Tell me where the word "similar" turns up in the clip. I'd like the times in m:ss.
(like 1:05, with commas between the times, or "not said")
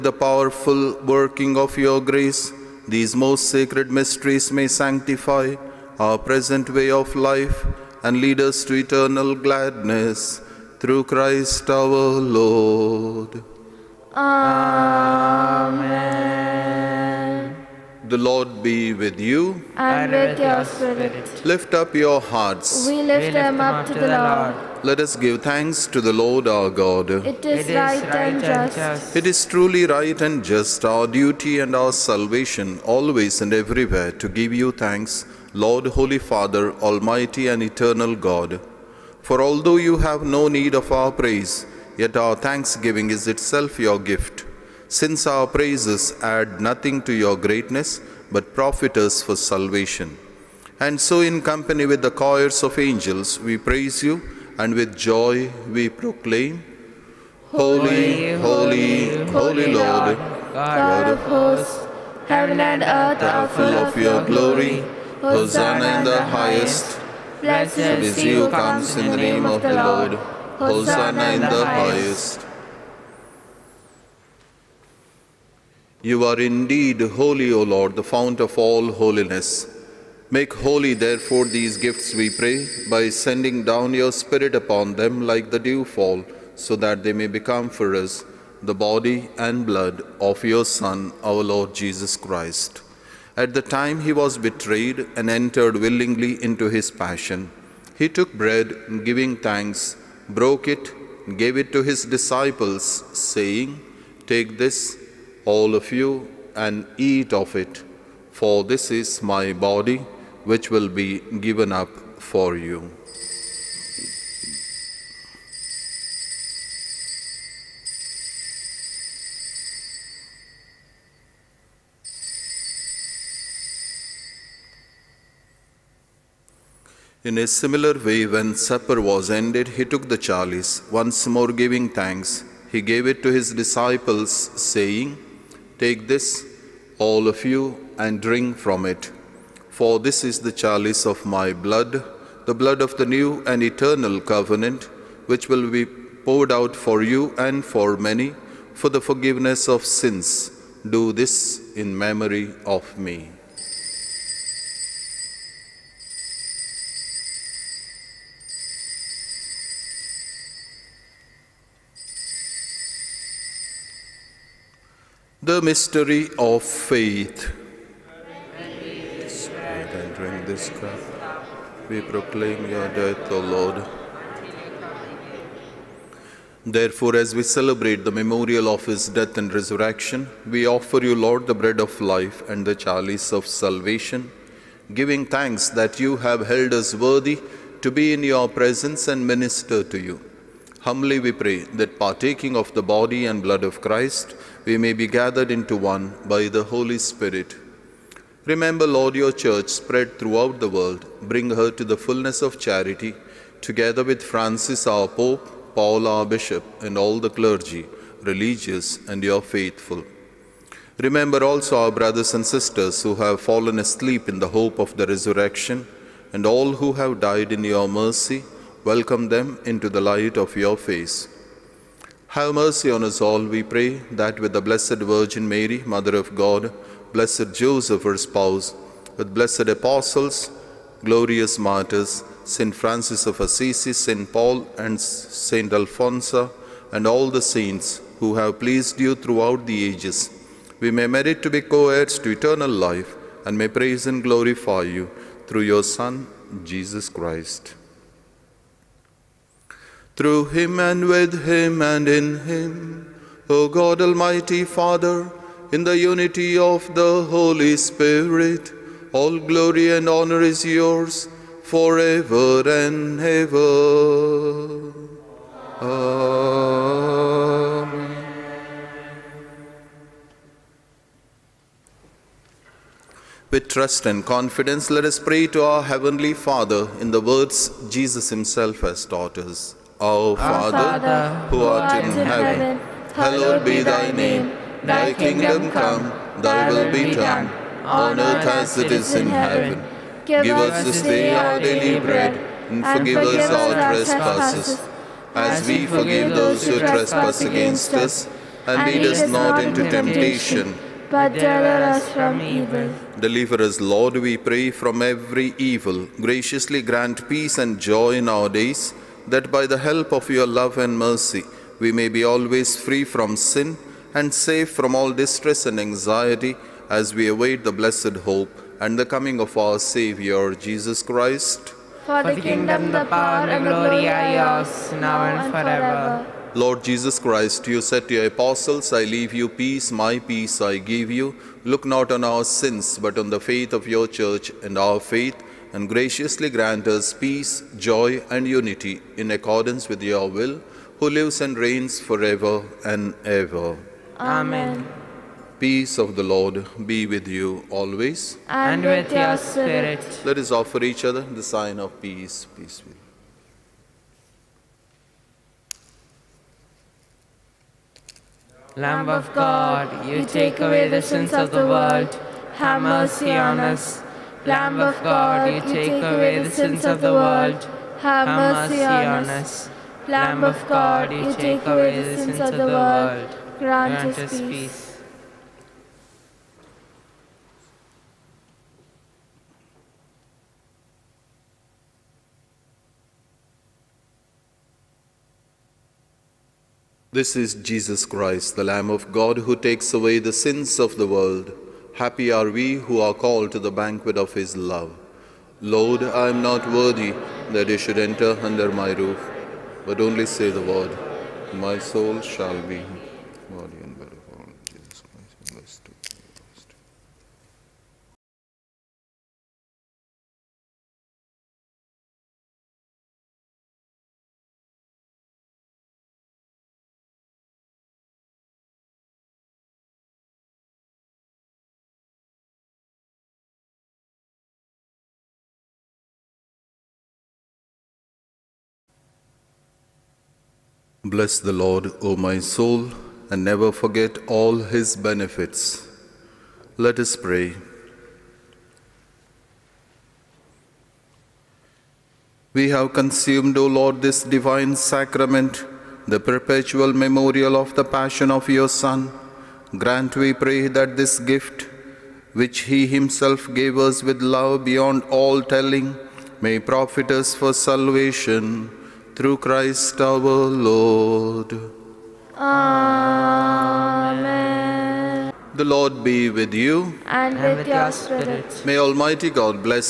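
2:07.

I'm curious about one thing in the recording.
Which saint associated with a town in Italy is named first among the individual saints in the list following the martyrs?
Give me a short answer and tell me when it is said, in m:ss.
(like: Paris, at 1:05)
St. Francis of Assisi, at 3:52.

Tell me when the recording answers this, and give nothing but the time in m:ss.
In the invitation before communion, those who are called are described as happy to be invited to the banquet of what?
6:33.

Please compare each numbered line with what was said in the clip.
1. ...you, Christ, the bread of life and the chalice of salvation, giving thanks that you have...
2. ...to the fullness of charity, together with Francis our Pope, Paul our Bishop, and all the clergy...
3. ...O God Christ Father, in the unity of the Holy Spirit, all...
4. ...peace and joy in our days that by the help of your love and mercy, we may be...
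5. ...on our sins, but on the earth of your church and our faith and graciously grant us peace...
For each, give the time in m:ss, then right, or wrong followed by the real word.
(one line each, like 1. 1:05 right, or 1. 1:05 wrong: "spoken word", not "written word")
1. 3:01 wrong: "Lord", not "Christ"
2. 3:21 right
3. 4:13 wrong: "Almighty", not "Christ"
4. 5:07 right
5. 5:32 wrong: "faith", not "earth".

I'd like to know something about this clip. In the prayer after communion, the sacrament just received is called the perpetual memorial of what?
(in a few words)
the passion of your Son.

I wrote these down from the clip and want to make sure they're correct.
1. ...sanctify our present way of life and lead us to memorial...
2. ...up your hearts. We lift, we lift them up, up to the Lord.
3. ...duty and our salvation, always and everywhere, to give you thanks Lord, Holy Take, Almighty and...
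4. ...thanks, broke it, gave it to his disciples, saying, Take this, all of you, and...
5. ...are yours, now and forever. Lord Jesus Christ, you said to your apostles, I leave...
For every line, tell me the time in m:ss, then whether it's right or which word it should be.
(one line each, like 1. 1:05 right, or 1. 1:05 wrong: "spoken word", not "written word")
1. 0:04 wrong: "eternal", not "memorial"
2. 0:21 right
3. 0:31 wrong: "Father", not "Take"
4. 1:39 right
5. 5:24 right.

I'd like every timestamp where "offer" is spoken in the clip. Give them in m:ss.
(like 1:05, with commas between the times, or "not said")
3:00, 5:50.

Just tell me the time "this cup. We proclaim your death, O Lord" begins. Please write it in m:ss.
2:50.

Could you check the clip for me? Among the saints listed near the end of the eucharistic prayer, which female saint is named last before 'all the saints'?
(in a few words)
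St. Alphonsa.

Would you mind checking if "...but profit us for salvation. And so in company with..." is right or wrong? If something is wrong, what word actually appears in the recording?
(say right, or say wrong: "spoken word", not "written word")
right.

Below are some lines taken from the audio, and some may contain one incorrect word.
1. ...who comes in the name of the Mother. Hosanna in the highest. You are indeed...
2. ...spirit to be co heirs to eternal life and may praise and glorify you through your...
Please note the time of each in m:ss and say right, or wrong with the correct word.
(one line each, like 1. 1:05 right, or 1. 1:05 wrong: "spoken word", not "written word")
1. 1:08 wrong: "Lord", not "Mother"
2. 4:01 wrong: "merit", not "spirit".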